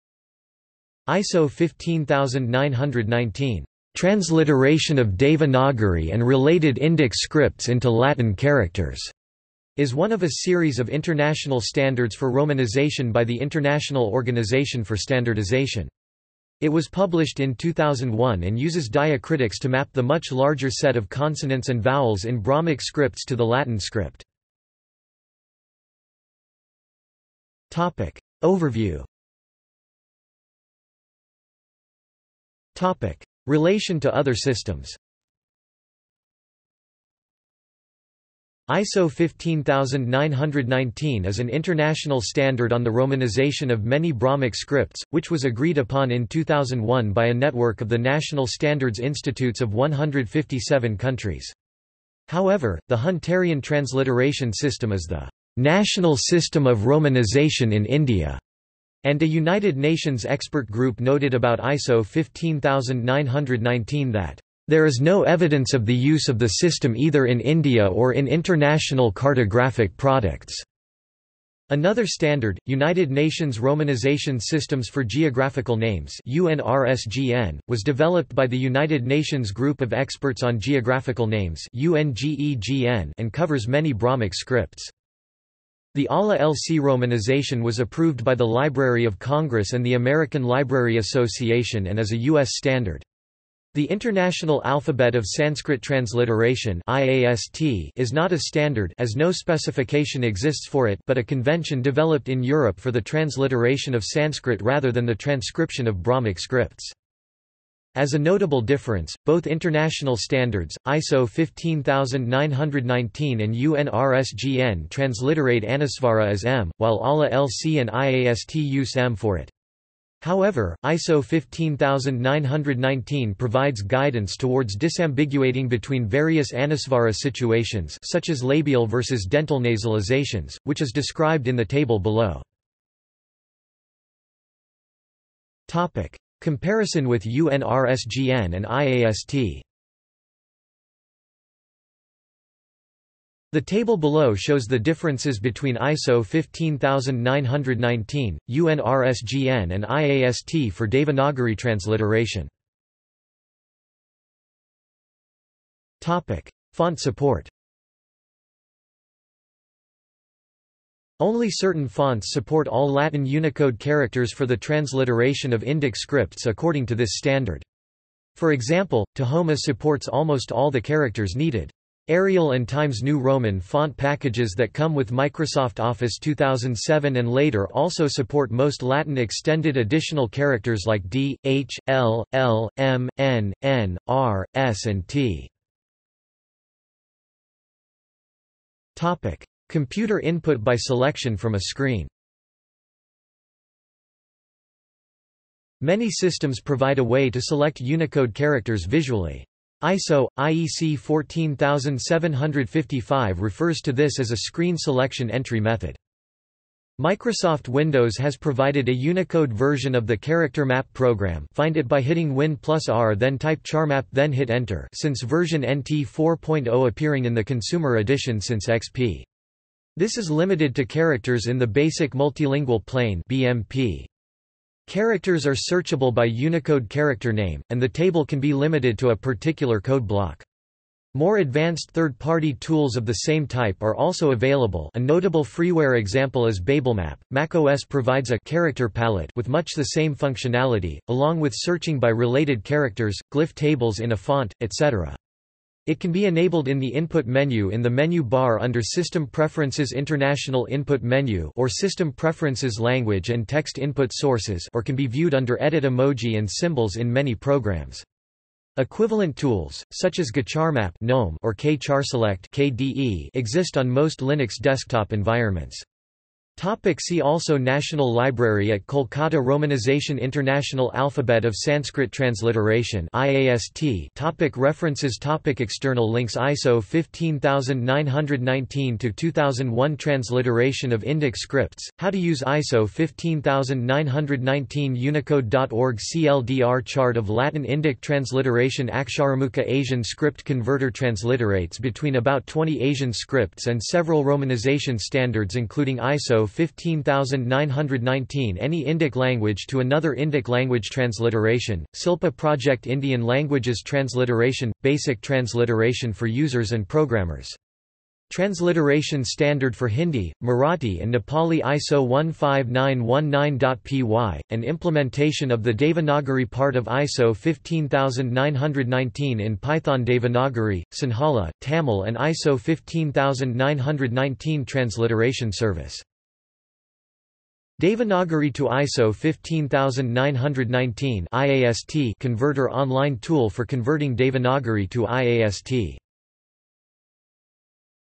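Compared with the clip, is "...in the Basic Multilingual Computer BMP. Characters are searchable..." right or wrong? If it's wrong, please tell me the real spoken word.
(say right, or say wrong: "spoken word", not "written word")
wrong: "Plane", not "Computer".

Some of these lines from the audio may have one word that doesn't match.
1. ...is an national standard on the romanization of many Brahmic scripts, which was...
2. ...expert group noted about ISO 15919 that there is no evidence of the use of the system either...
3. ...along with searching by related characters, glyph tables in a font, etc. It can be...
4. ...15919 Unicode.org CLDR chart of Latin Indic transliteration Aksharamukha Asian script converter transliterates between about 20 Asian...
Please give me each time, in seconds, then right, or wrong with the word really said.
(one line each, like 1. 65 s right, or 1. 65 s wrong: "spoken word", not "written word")
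1. 41 s wrong: "international", not "national"
2. 60 s right
3. 241 s right
4. 282 s right.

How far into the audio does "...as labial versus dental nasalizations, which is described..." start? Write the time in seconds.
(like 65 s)
128 s.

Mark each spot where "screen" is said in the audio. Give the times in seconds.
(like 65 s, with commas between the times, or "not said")
191 s, 204 s.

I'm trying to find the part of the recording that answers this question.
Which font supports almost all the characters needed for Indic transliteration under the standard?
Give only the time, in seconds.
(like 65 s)
169 s.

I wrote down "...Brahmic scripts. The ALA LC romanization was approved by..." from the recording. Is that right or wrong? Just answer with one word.
right.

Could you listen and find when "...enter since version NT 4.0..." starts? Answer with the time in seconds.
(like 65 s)
214 s.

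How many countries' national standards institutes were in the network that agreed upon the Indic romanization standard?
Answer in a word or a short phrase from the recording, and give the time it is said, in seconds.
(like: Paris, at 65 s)
157, at 49 s.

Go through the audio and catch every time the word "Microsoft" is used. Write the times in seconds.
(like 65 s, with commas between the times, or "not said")
175 s, 206 s.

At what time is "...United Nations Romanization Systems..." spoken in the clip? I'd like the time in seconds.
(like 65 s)
72 s.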